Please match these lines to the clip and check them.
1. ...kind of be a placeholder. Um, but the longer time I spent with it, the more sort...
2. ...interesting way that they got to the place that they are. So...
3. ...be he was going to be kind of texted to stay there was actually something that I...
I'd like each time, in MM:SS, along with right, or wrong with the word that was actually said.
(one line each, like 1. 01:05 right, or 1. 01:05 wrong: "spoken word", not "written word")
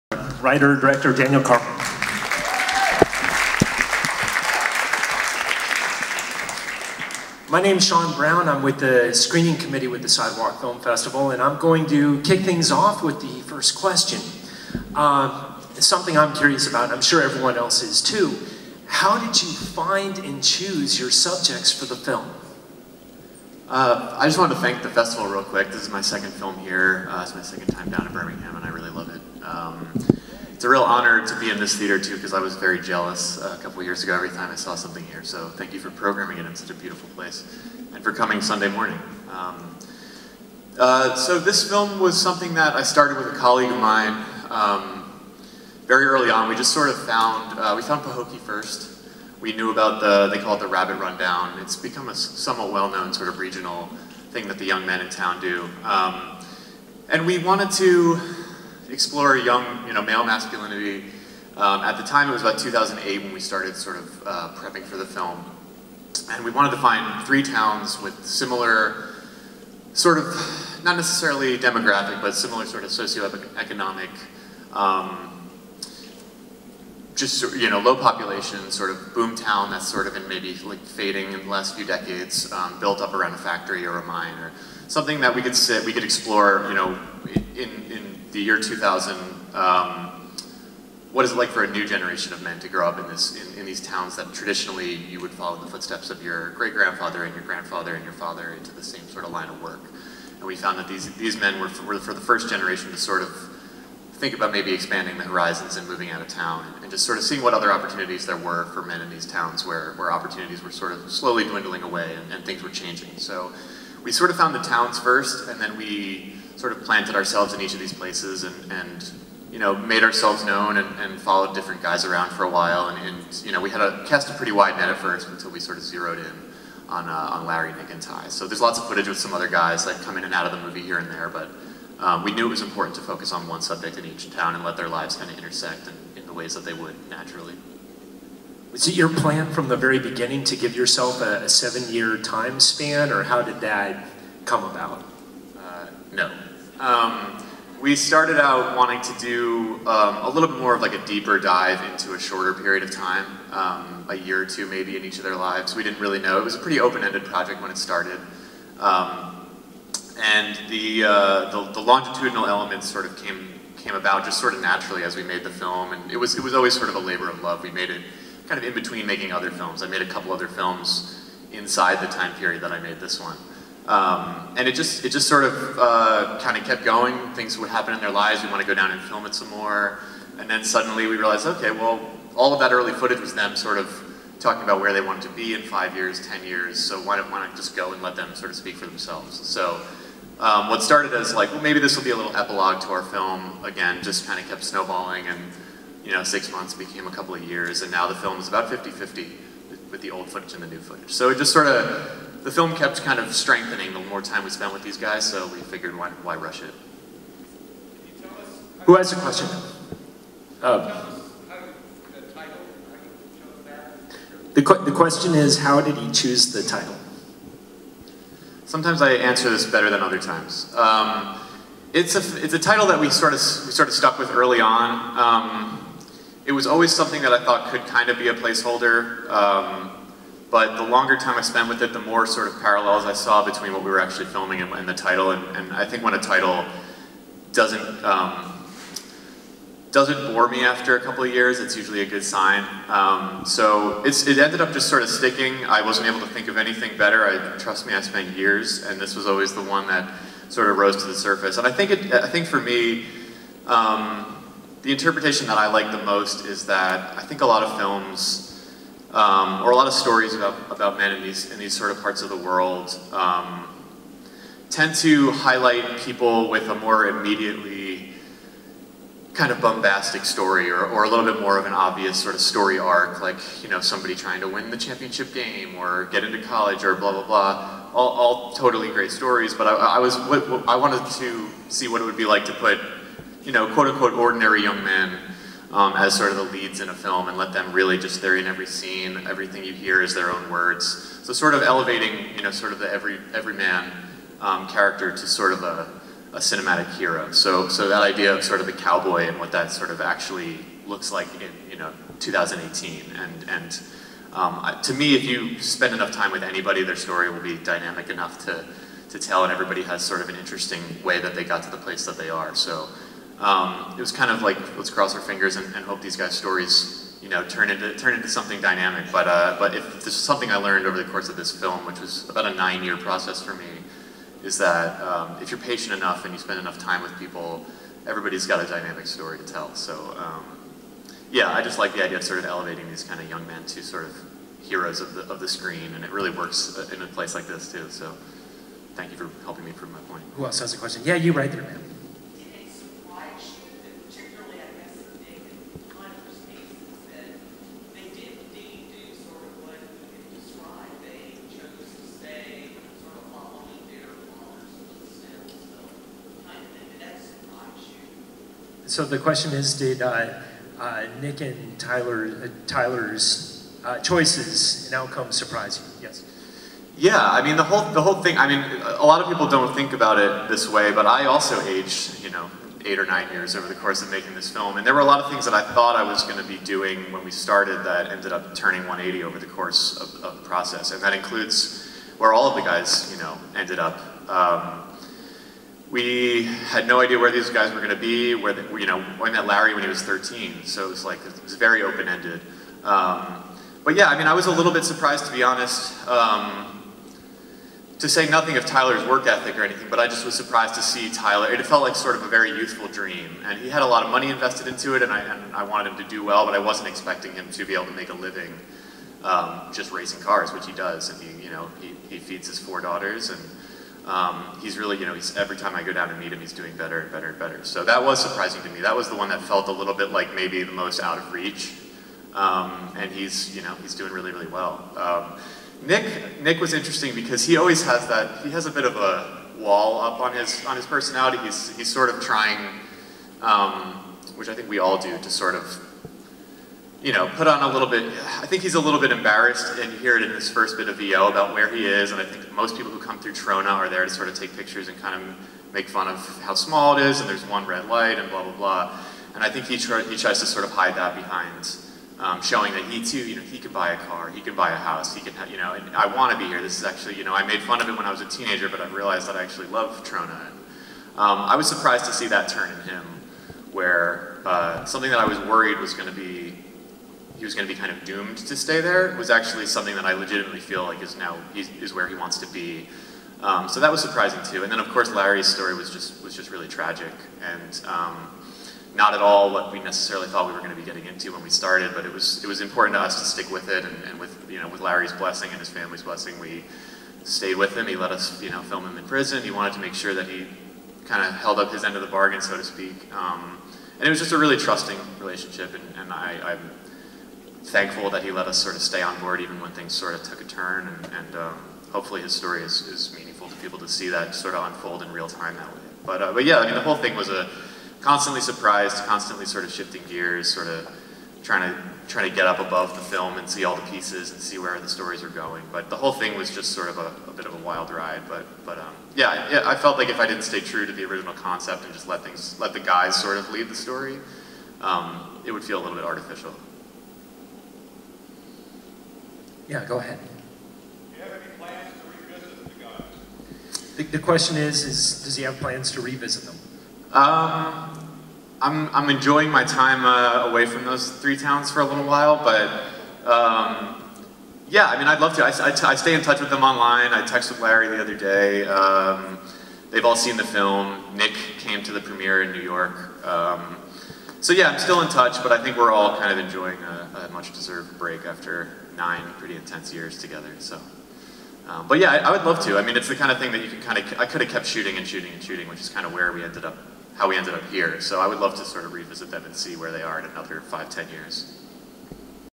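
1. 03:47 right
2. 05:10 right
3. 07:46 wrong: "doomed", not "texted".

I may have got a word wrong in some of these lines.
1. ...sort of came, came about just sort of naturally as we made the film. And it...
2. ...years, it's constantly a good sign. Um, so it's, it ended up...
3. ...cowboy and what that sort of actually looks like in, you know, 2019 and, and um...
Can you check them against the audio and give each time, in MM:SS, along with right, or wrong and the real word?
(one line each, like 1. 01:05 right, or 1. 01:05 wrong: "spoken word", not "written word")
1. 02:42 right
2. 04:01 wrong: "usually", not "constantly"
3. 04:58 wrong: "2018", not "2019".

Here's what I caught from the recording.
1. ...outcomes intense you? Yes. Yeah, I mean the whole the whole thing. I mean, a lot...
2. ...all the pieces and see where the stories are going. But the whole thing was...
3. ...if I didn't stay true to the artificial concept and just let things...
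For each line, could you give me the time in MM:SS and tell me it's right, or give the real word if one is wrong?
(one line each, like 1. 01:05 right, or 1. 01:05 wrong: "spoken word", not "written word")
1. 06:04 wrong: "surprise", not "intense"
2. 08:33 right
3. 08:40 wrong: "original", not "artificial".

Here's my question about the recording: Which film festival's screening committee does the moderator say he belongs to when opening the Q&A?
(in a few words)
Sidewalk Film Festival.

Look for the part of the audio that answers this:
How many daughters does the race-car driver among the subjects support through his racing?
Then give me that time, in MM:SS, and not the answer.
06:52.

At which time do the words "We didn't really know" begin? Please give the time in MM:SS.
02:35.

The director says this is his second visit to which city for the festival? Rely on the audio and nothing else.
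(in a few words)
Birmingham.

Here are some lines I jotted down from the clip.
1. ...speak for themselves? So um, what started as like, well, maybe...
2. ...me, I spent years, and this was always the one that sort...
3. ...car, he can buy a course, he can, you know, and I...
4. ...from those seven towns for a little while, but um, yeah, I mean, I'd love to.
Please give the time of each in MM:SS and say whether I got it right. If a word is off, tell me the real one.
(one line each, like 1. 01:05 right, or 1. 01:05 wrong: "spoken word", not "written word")
1. 03:08 right
2. 04:07 right
3. 07:33 wrong: "house", not "course"
4. 09:00 wrong: "three", not "seven".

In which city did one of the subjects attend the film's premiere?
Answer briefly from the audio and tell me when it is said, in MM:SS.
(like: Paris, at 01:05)
New York, at 09:12.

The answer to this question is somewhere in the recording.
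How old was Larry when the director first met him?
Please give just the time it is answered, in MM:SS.
06:30.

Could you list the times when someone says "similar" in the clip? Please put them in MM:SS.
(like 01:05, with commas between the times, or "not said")
01:08, 01:12.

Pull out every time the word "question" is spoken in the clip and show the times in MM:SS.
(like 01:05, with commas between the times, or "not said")
00:13, 03:29, 03:34, 05:40, 05:59, 08:54.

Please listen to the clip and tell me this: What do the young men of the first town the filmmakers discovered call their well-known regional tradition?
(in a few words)
Rabbit Rundown.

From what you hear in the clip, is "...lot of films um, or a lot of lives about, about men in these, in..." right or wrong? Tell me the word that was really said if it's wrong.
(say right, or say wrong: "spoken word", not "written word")
wrong: "stories", not "lives".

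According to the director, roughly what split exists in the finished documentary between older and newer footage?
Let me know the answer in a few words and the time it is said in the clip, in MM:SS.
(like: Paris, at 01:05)
50-50, at 03:18.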